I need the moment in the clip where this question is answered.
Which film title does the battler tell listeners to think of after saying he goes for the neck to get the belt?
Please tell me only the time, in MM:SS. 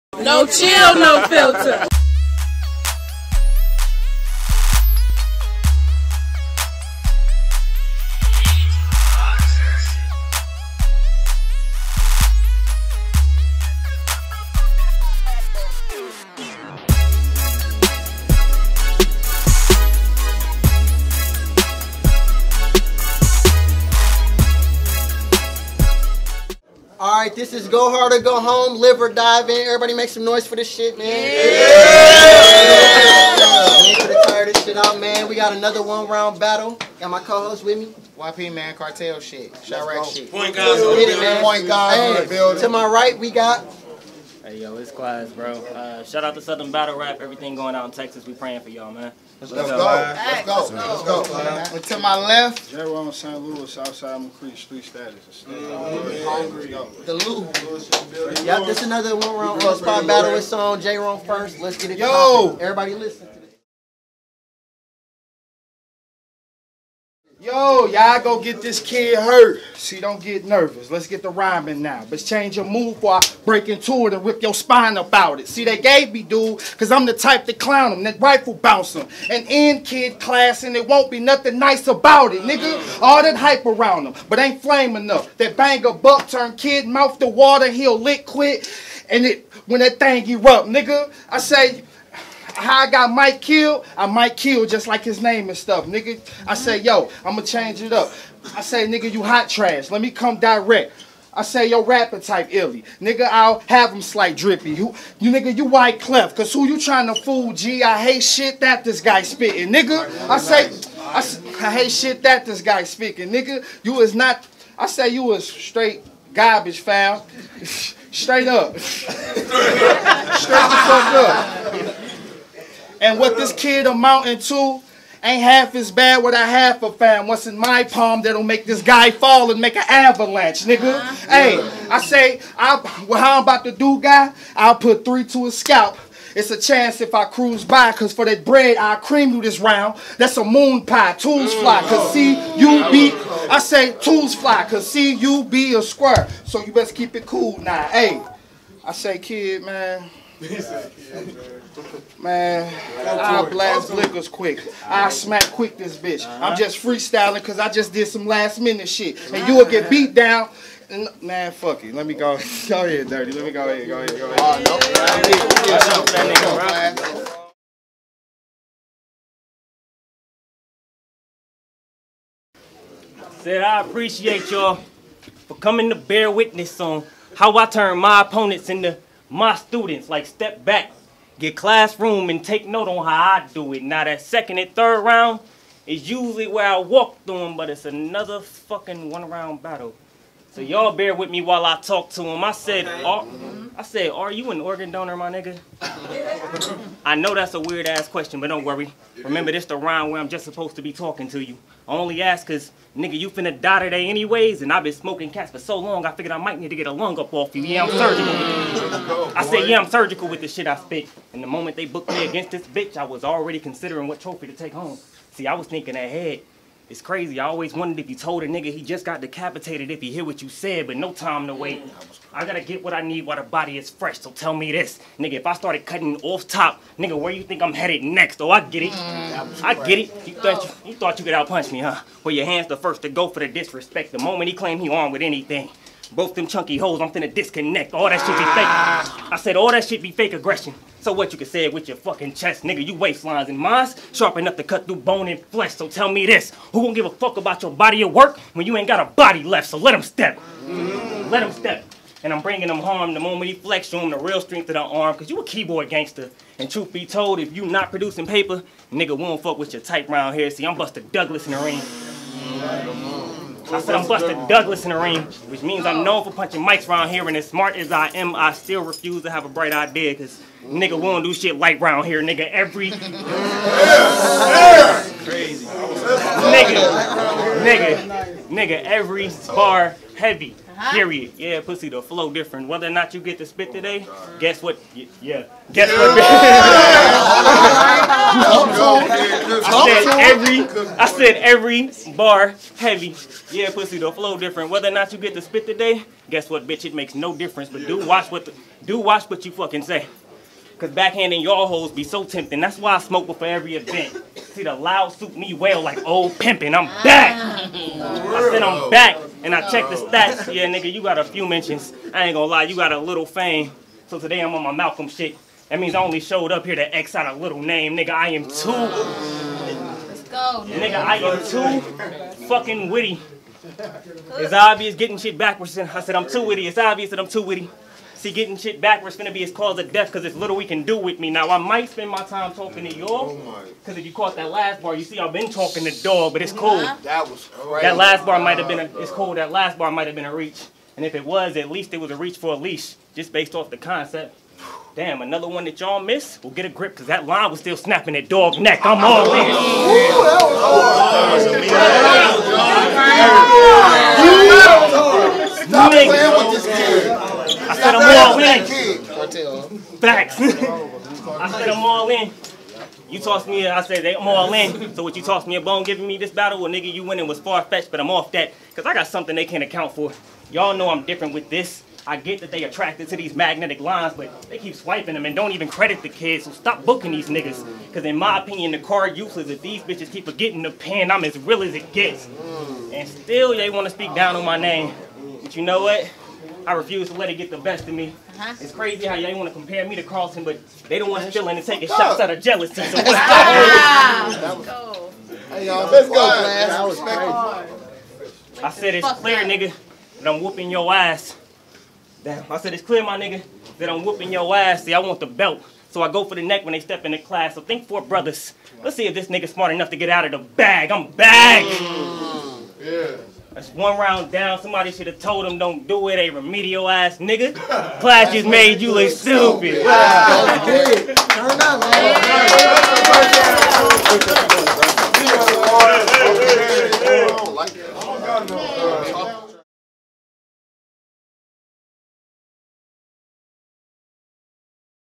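06:47.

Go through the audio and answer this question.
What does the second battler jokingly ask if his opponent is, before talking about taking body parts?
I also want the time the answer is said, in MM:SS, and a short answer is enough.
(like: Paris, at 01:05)
An organ donor, at 03:14.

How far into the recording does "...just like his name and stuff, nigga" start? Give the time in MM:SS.
01:34.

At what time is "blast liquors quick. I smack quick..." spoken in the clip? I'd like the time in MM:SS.
02:33.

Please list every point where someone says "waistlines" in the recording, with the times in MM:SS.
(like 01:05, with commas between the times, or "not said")
04:02.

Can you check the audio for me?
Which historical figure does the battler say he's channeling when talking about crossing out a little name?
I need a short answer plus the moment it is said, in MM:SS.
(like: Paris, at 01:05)
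Malcolm, at 05:14.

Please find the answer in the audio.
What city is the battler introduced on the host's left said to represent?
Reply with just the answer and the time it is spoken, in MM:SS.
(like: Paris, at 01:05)
St. Louis, at 00:53.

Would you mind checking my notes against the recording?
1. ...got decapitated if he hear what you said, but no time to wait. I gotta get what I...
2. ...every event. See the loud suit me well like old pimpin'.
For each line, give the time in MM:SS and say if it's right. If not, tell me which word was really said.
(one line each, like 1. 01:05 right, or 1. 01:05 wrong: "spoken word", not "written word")
1. 03:39 right
2. 05:03 right.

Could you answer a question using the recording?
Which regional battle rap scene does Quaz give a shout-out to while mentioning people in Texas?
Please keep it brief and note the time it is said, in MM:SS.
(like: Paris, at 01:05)
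Southern Battle Rap, at 00:46.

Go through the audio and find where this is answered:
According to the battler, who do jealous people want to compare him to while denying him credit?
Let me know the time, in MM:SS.
06:30.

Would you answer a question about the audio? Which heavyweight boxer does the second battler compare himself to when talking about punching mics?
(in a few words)
Buster Douglas.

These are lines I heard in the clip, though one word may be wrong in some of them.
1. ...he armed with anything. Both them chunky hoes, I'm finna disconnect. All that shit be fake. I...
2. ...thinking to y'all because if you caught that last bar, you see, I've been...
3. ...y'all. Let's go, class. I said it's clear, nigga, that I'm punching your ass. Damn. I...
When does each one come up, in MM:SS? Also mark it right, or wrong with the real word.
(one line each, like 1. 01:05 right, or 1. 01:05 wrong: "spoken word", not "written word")
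1. 03:54 right
2. 05:32 wrong: "talking", not "thinking"
3. 06:35 wrong: "whooping", not "punching".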